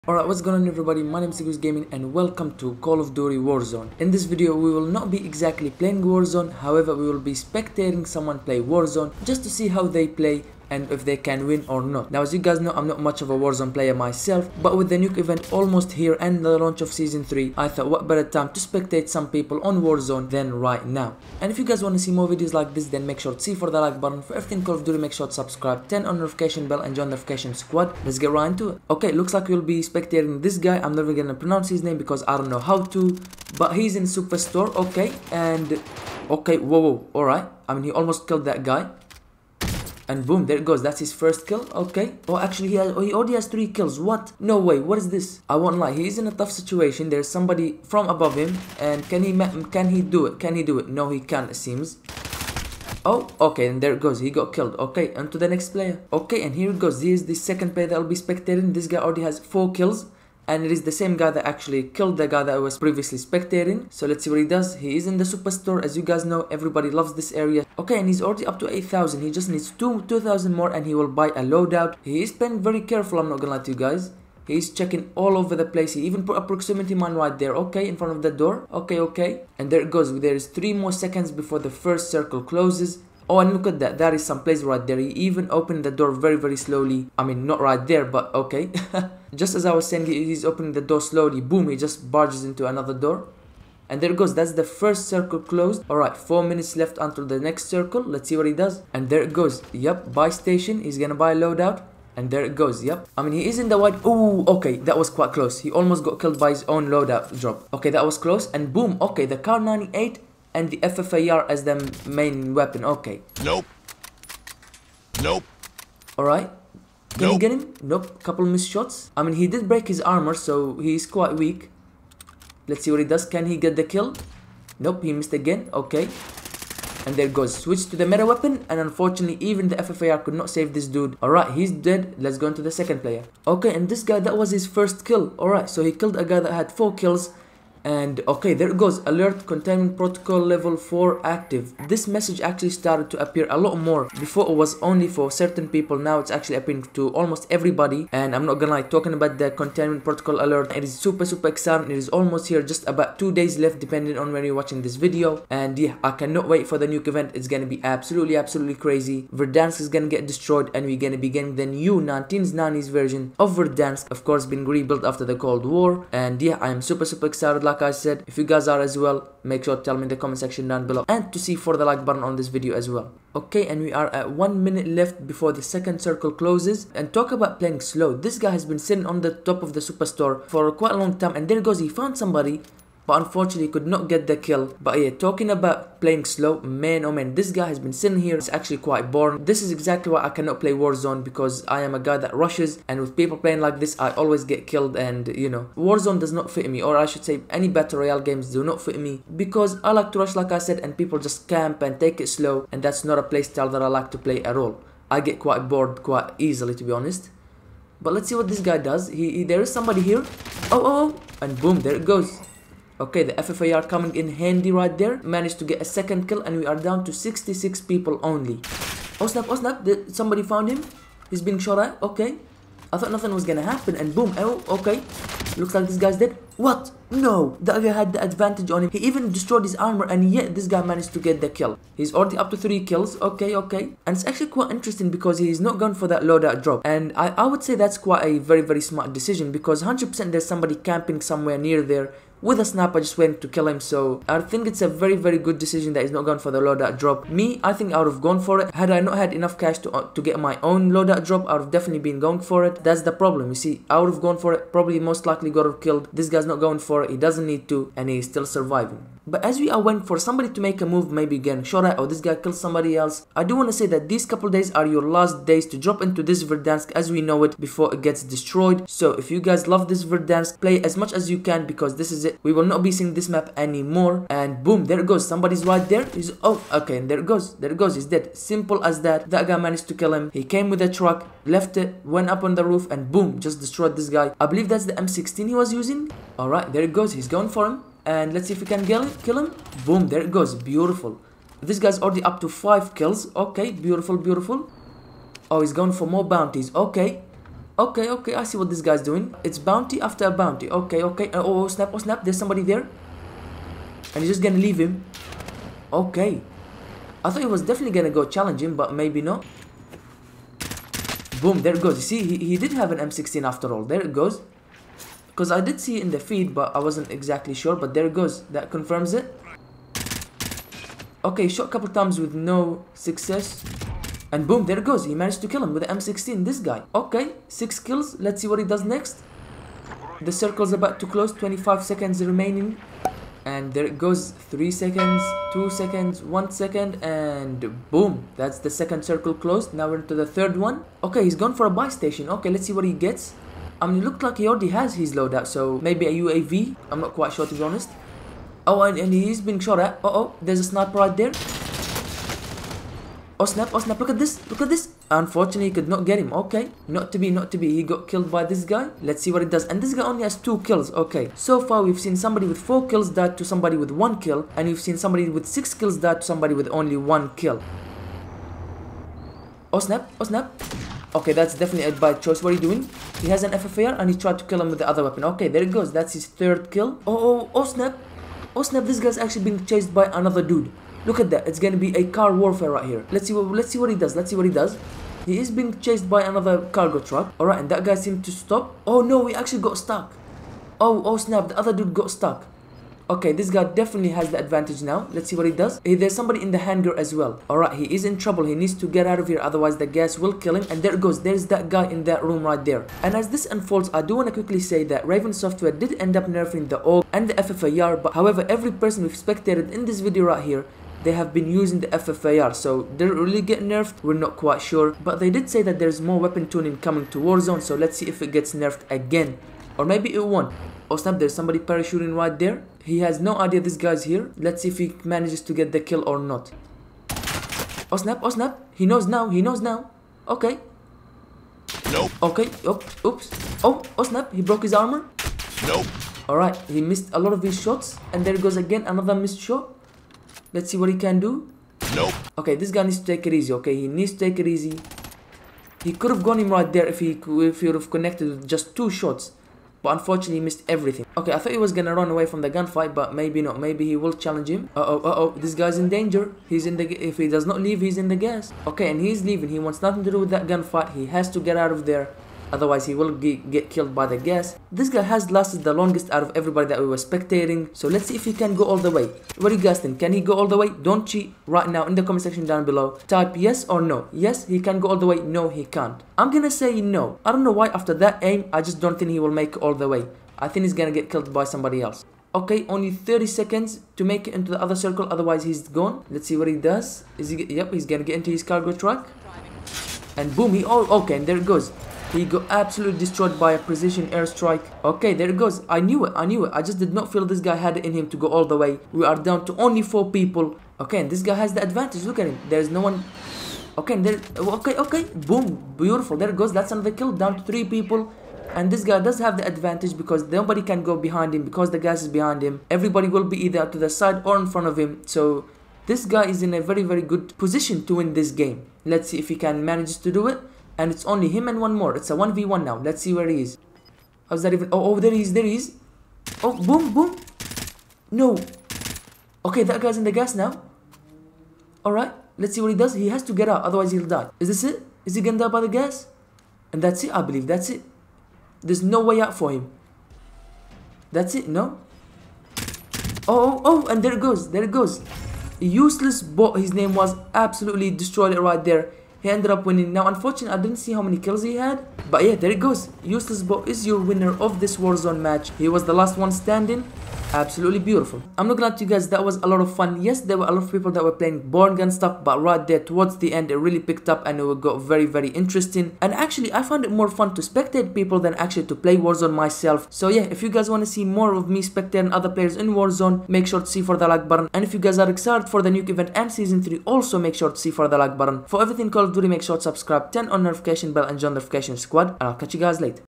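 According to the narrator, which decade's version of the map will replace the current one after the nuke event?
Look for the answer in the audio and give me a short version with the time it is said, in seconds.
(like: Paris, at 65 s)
1990s, at 161 s.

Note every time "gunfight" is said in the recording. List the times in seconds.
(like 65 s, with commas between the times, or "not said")
452 s, 460 s.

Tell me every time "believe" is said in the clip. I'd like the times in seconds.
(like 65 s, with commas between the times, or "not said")
284 s, 537 s.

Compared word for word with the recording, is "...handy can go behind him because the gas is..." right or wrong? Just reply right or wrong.
wrong.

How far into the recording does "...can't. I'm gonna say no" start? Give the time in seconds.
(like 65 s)
475 s.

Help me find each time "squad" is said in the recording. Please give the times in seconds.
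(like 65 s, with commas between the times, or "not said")
27 s, 581 s.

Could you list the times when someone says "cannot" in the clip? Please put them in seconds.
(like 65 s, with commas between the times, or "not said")
156 s, 190 s.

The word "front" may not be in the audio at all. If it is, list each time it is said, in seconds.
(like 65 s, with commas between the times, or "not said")
77 s, 514 s.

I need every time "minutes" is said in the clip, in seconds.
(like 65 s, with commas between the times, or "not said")
96 s, 174 s.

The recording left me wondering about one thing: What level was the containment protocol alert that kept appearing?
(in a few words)
4.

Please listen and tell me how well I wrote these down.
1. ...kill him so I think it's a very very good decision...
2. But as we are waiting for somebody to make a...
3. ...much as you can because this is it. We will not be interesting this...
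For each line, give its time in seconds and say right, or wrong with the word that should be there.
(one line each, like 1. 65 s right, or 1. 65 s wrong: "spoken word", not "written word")
1. 243 s right
2. 259 s right
3. 270 s wrong: "seeing", not "interesting".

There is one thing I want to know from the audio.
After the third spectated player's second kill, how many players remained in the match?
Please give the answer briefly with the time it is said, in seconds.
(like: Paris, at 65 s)
66, at 216 s.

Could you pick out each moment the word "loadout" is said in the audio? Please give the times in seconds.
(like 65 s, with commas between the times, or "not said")
71 s, 101 s, 106 s, 236 s, 246 s, 250 s, 345 s.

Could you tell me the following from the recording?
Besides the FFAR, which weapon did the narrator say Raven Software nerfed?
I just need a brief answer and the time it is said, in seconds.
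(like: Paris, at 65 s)
AUG, at 406 s.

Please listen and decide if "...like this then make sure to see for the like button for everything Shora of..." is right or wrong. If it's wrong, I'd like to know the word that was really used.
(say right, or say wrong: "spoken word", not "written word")
wrong: "Call", not "Shora".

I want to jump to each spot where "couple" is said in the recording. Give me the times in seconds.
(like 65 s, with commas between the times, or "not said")
118 s, 264 s, 321 s.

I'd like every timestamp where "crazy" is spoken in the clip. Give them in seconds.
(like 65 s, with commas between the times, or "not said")
158 s.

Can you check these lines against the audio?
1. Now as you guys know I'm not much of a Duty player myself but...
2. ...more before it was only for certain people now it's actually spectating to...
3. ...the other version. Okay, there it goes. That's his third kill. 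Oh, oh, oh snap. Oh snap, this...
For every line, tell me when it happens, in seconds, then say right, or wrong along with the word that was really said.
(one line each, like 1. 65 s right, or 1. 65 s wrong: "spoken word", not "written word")
1. 12 s wrong: "Warzone", not "Duty"
2. 143 s wrong: "appearing", not "spectating"
3. 374 s wrong: "weapon", not "version".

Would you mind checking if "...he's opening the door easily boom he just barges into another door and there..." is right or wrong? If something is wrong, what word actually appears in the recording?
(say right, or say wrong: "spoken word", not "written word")
wrong: "slowly", not "easily".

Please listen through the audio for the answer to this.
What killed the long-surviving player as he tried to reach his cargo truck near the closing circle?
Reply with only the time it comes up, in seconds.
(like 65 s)
493 s.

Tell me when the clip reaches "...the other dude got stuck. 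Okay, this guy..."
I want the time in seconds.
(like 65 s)
391 s.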